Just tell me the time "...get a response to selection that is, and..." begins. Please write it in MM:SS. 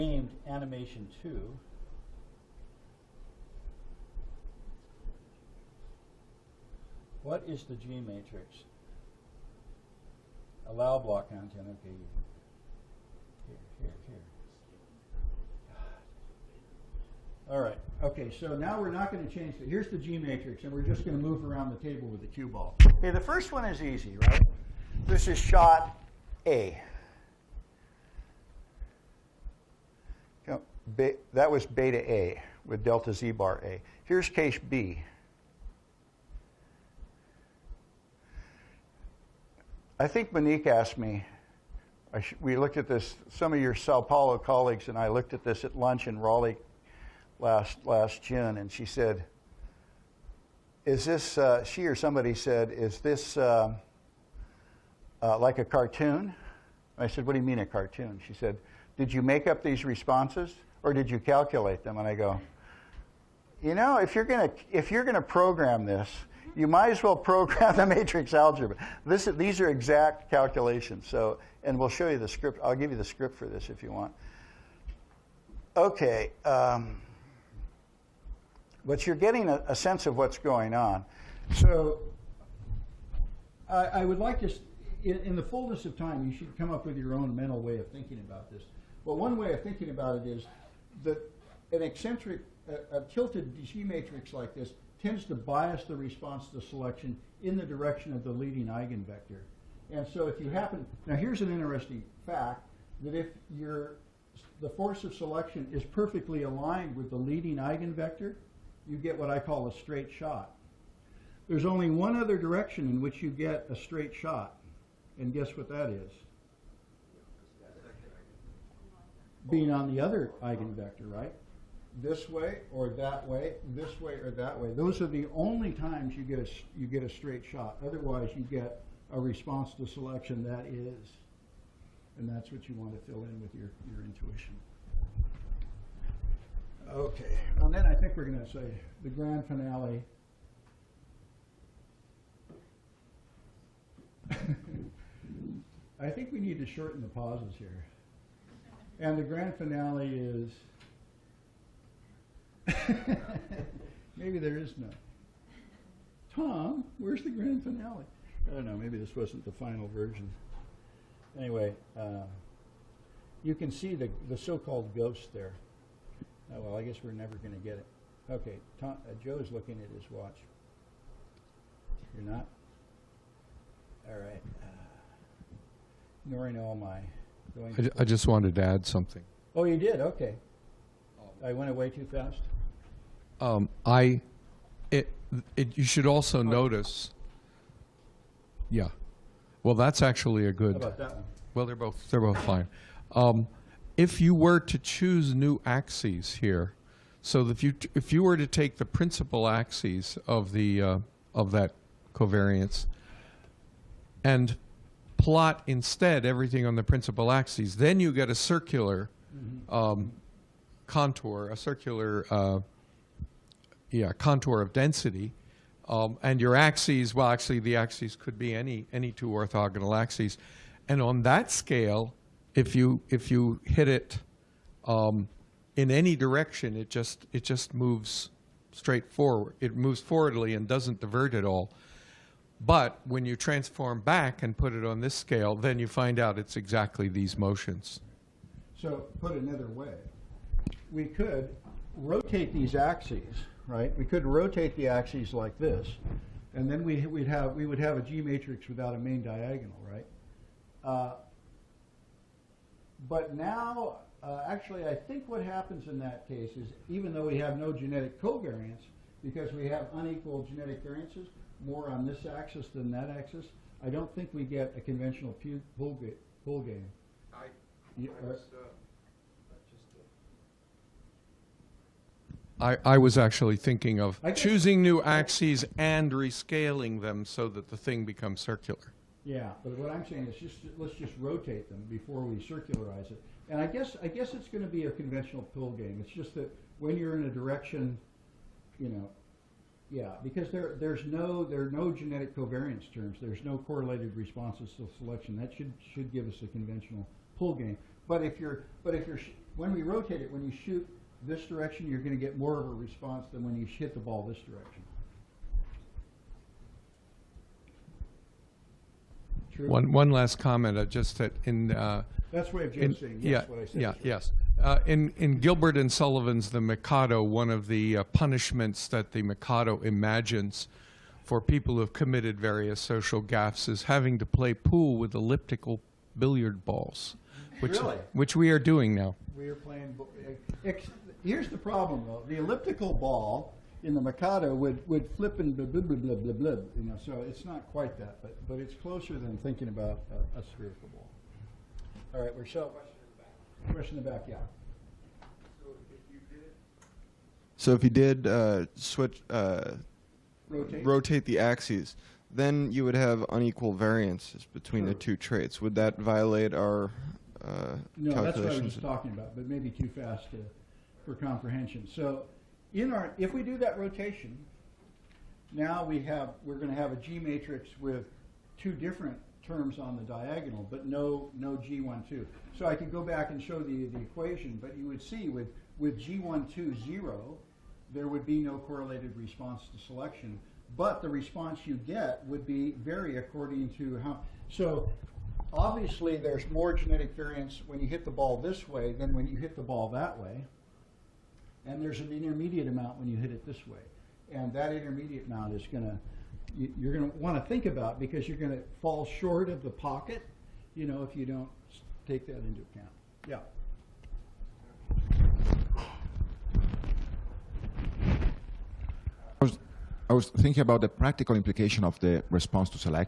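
02:08.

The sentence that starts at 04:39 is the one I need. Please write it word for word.
Yeah, but what I'm saying is just let's just rotate them before we circularize it.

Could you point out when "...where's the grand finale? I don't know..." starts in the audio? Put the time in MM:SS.
02:36.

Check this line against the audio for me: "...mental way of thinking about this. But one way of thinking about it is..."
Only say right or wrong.
right.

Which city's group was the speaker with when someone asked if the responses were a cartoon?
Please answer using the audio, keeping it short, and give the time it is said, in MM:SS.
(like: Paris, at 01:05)
Sao Paulo, at 00:43.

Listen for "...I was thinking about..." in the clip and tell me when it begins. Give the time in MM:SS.
06:50.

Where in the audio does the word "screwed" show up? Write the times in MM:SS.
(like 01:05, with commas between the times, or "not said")
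not said.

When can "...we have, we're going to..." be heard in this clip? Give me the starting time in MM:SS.
06:05.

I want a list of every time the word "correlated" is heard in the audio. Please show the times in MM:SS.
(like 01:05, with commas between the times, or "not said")
04:53, 06:18.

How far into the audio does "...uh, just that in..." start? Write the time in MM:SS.
05:10.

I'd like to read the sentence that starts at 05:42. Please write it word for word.
All right, we're showing Question in the back, Question in the back.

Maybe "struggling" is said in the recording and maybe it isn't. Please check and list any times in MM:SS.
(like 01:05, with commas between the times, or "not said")
not said.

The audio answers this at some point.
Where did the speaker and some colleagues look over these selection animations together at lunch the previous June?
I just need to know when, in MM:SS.
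00:46.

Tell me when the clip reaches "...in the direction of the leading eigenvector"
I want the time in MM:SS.
01:37.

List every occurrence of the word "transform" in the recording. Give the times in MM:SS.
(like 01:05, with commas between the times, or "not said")
03:53.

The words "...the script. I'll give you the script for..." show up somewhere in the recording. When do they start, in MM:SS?
01:12.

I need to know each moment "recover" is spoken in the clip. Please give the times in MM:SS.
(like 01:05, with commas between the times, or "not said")
not said.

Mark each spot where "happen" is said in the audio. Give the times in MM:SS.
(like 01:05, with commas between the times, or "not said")
01:40, 04:15.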